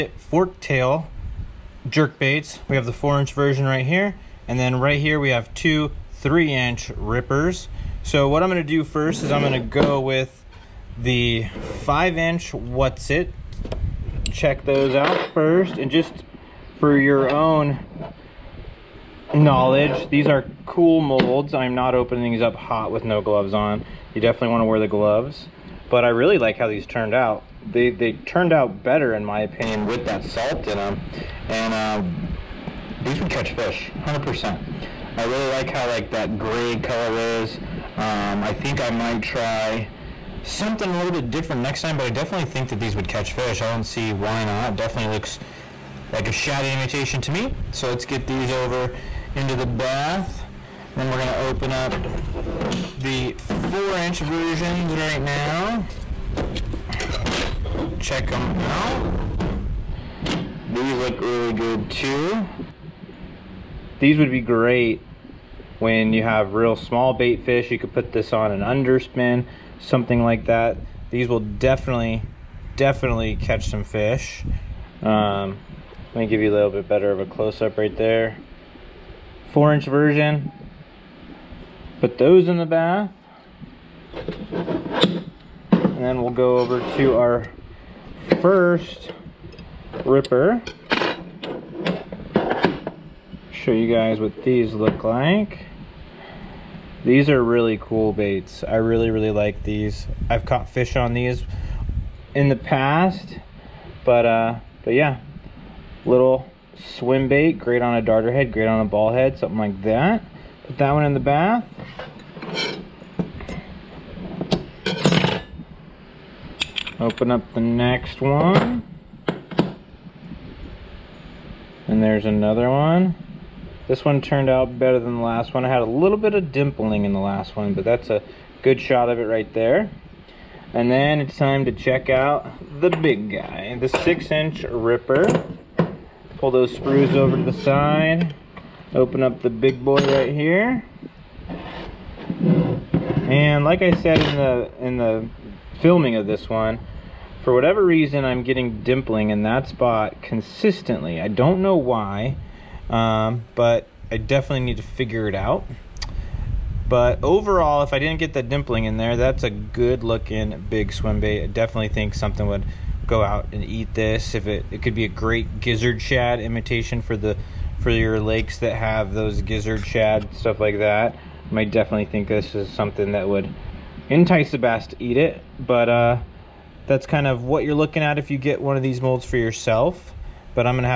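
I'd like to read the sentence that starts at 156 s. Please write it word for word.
But overall, if I didn't get that dimpling in there, that's a good looking big swim bait.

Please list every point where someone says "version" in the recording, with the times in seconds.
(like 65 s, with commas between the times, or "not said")
3 s, 54 s, 79 s.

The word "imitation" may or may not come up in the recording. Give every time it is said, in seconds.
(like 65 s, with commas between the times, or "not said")
46 s, 166 s.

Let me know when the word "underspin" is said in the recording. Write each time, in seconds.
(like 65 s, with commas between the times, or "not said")
68 s.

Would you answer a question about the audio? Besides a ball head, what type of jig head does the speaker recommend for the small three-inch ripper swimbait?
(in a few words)
darter head.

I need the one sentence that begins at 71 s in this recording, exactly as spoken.
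These will definitely, definitely catch some fish.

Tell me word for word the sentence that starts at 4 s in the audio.
And then right here, we have two three inch rippers.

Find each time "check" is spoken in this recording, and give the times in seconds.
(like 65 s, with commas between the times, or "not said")
14 s, 57 s, 131 s.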